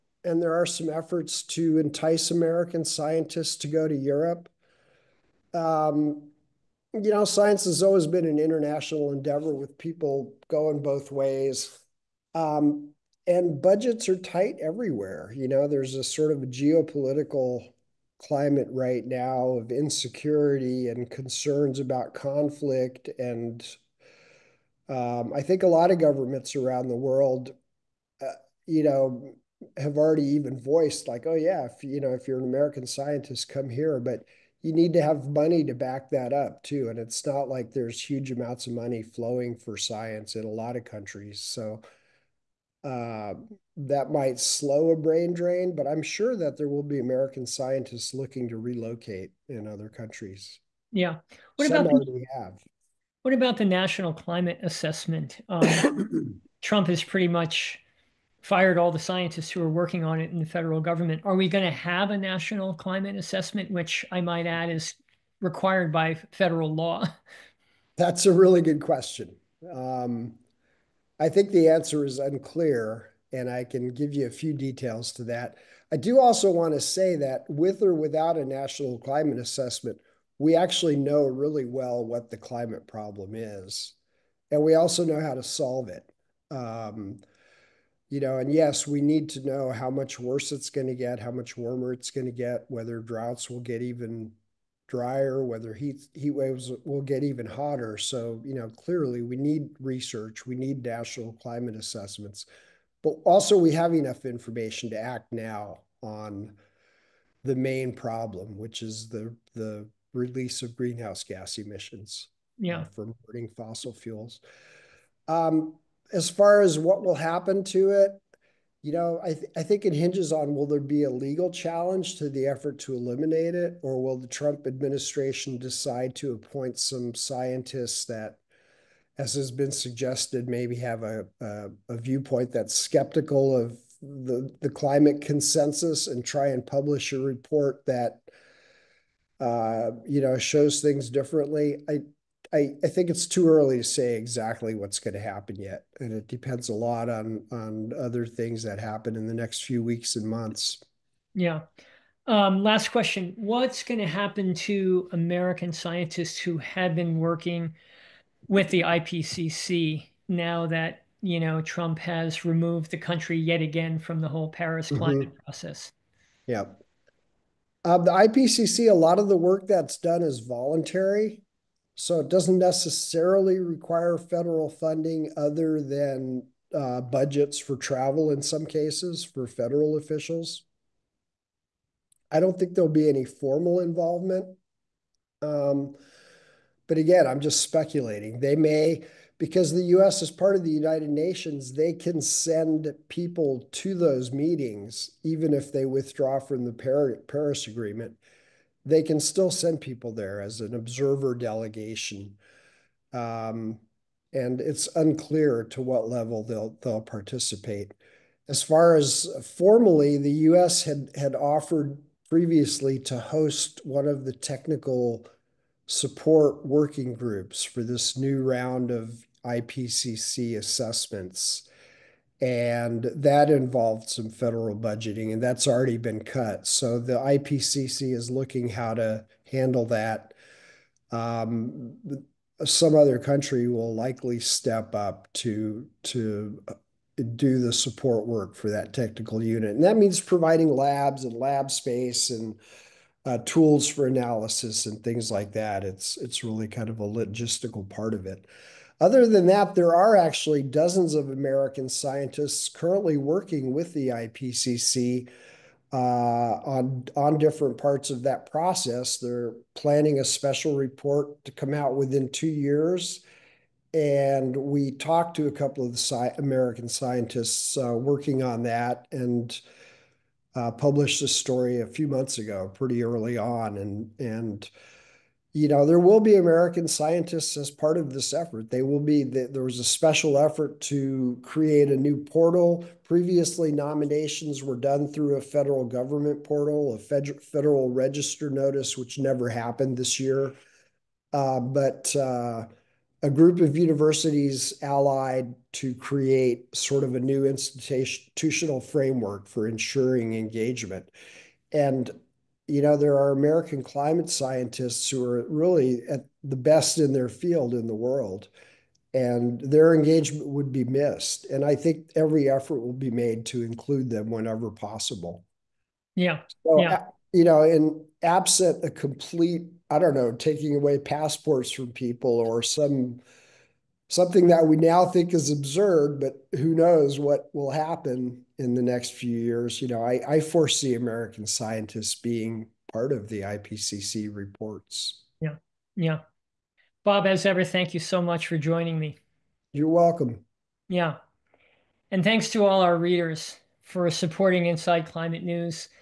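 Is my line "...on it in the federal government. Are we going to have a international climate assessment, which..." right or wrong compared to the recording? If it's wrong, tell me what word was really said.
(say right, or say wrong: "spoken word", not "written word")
wrong: "national", not "international".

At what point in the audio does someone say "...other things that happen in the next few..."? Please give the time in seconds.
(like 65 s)
147 s.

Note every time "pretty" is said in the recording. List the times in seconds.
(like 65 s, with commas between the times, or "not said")
57 s, 272 s.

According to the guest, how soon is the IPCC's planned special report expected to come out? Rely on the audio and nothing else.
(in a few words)
2 years.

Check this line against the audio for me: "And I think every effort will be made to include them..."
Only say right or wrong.
right.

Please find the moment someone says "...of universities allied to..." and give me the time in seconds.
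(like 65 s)
293 s.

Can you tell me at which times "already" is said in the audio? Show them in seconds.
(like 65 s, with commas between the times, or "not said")
29 s, 225 s.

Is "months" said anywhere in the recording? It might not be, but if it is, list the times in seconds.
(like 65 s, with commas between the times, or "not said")
150 s, 272 s.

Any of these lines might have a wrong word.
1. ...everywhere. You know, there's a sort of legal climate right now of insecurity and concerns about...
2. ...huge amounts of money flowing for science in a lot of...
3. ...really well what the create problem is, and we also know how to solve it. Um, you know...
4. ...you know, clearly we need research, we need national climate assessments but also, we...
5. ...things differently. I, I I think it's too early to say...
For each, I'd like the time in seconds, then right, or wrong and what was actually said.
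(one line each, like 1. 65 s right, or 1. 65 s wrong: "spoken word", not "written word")
1. 14 s wrong: "geopolitical", not "legal"
2. 38 s right
3. 81 s wrong: "climate", not "create"
4. 98 s right
5. 140 s right.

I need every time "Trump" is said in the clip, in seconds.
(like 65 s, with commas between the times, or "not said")
56 s, 124 s, 161 s.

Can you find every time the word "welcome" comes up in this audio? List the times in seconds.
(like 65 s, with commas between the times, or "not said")
339 s.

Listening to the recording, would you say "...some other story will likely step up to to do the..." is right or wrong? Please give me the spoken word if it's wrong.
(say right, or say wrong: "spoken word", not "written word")
wrong: "country", not "story".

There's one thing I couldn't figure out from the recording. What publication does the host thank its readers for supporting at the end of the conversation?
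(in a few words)
Inside Climate News.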